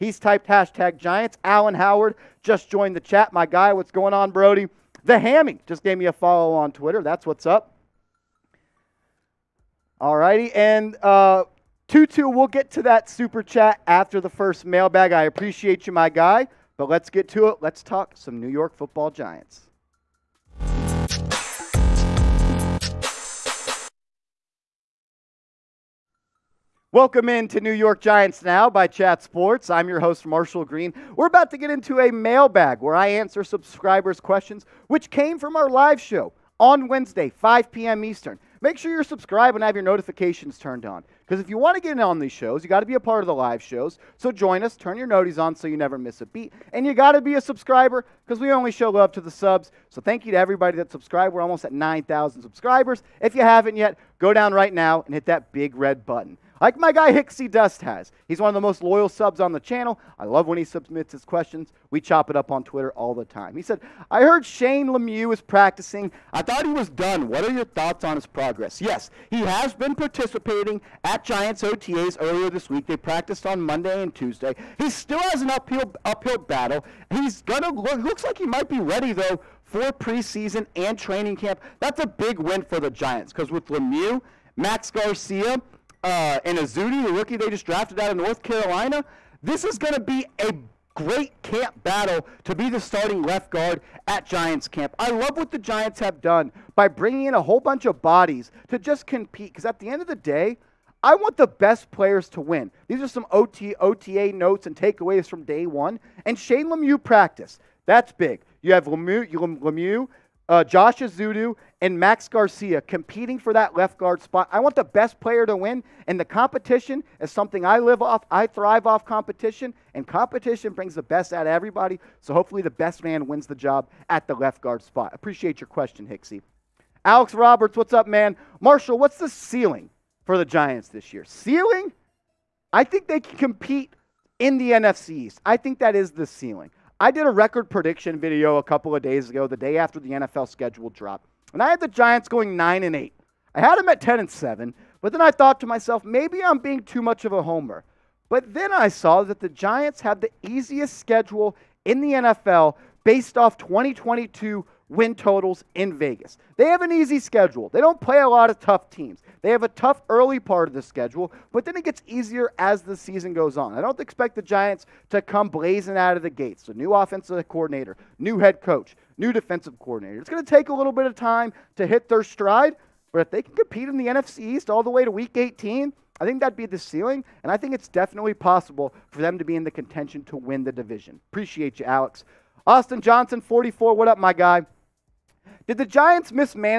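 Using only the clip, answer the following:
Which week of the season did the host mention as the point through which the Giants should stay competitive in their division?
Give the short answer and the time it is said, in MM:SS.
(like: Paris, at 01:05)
Week 18, at 02:55.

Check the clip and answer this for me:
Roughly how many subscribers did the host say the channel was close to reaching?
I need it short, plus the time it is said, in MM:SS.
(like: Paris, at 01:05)
9,000, at 00:51.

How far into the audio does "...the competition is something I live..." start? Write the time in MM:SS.
01:56.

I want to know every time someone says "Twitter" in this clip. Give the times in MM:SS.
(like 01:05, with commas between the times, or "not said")
00:06, 01:02.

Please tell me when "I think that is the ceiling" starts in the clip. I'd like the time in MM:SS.
02:15.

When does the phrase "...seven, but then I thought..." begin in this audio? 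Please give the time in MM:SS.
02:24.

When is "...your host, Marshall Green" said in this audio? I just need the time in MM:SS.
00:29.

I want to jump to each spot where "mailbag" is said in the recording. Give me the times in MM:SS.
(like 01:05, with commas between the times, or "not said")
00:14, 00:32.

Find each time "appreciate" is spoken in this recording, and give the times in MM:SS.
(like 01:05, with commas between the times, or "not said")
00:15, 02:05, 03:01.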